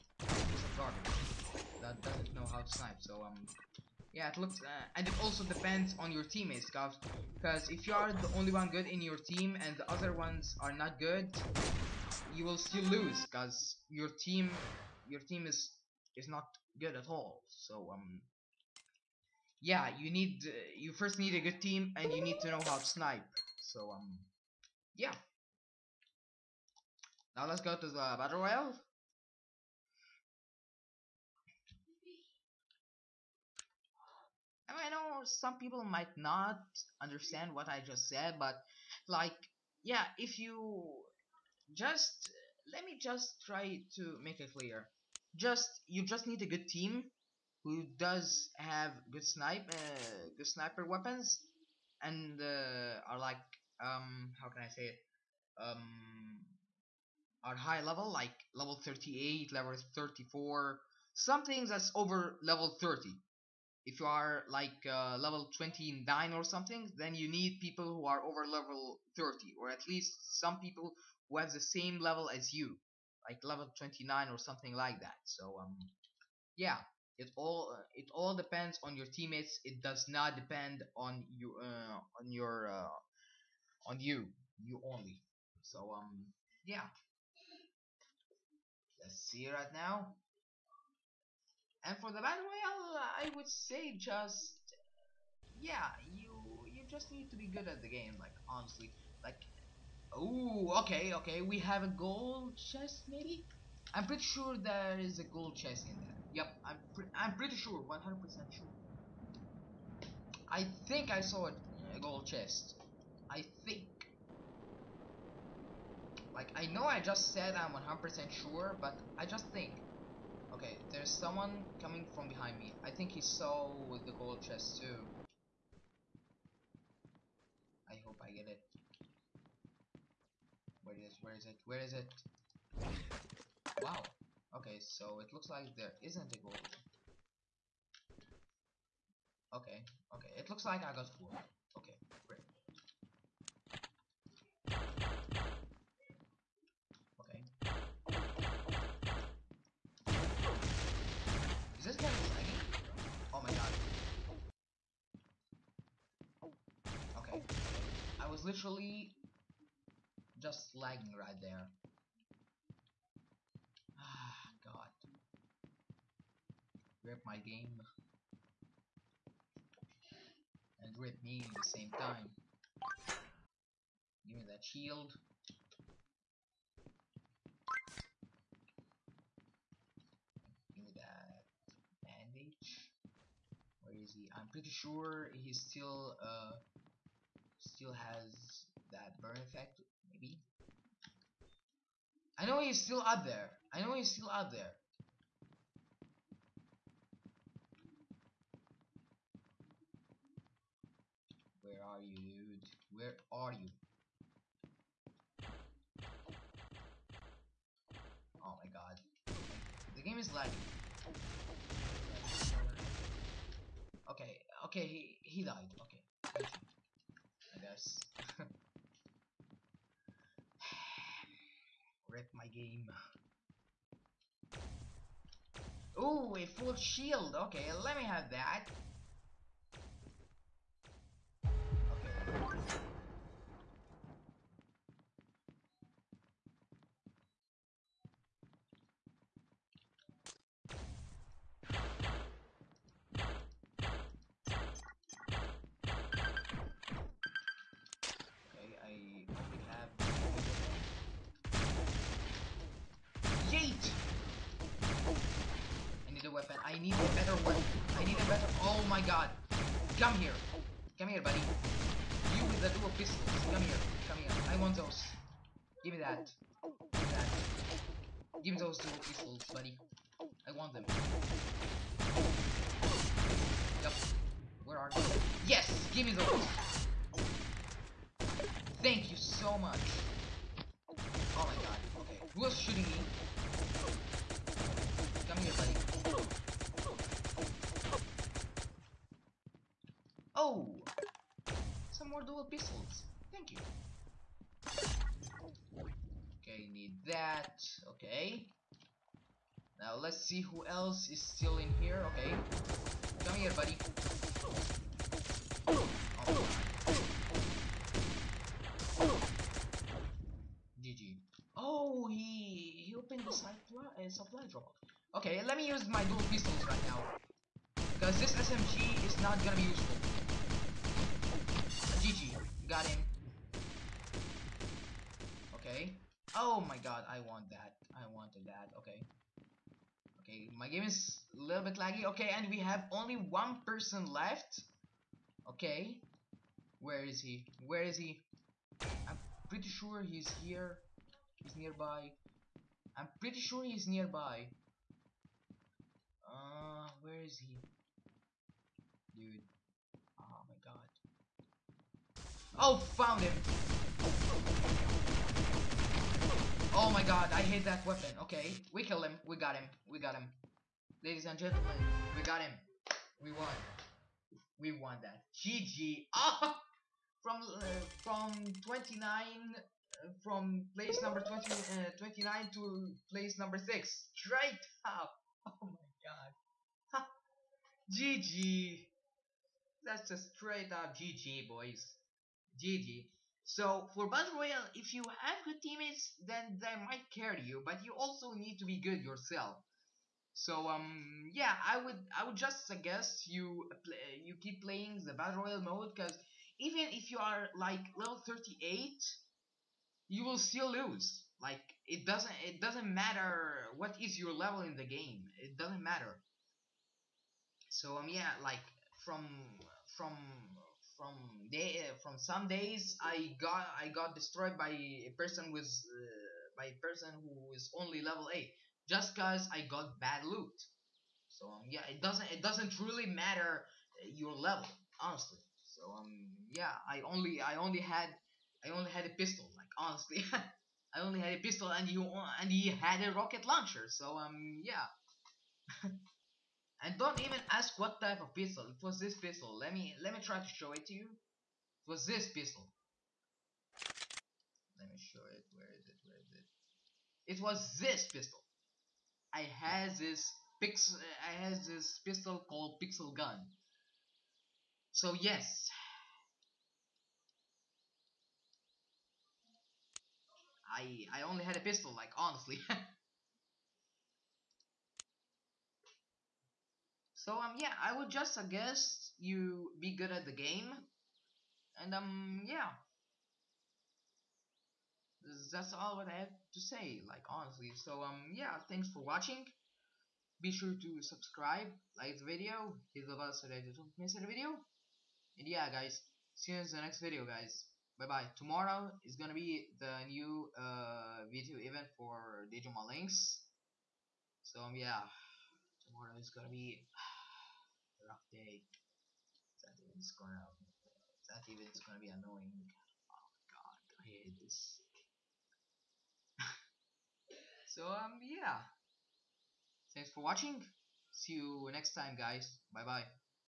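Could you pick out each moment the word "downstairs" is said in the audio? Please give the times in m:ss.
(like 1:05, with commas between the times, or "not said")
not said.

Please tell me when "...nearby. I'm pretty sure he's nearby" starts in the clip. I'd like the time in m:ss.
5:41.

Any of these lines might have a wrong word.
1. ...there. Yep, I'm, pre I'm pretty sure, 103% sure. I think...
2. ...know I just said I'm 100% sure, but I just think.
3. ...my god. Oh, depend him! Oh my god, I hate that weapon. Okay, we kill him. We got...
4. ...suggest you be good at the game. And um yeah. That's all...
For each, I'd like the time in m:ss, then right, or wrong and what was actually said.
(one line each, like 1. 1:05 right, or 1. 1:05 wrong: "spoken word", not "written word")
1. 1:46 wrong: "100", not "103"
2. 1:56 right
3. 5:50 wrong: "found", not "depend"
4. 7:48 right.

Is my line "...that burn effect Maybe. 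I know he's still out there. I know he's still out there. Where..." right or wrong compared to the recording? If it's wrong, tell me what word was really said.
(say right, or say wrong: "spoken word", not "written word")
right.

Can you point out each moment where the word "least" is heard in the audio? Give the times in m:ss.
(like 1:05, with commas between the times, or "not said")
1:09.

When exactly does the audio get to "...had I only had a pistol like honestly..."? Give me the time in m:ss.
7:07.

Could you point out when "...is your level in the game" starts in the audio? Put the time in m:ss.
6:44.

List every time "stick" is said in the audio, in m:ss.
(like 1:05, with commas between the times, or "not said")
not said.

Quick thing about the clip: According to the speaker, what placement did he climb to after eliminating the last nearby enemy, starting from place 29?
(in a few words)
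6.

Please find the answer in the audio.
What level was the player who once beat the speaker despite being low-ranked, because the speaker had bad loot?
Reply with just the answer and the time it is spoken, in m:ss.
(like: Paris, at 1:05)
level 8, at 6:58.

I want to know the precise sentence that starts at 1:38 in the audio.
Like honestly, like Ooh, okay, okay.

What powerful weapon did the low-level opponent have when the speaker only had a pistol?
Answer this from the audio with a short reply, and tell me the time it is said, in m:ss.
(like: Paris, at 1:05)
rocket launcher, at 7:13.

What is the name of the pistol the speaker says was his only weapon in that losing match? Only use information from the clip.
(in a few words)
Pixel Gun.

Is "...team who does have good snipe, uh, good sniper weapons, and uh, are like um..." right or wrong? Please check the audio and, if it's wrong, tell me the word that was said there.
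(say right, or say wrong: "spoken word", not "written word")
right.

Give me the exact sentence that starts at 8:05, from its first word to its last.
And yeah guys, see you in the next video guys.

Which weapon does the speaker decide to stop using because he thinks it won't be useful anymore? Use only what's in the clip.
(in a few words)
SMG.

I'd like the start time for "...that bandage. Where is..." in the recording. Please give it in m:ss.
3:00.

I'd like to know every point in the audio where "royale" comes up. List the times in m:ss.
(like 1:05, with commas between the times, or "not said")
0:28, 1:32, 6:24, 6:35.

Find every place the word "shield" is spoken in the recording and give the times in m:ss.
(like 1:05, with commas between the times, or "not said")
2:54, 3:46.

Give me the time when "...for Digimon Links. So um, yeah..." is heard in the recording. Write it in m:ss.
8:11.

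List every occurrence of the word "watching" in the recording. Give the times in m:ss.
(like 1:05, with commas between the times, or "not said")
7:59, 8:30.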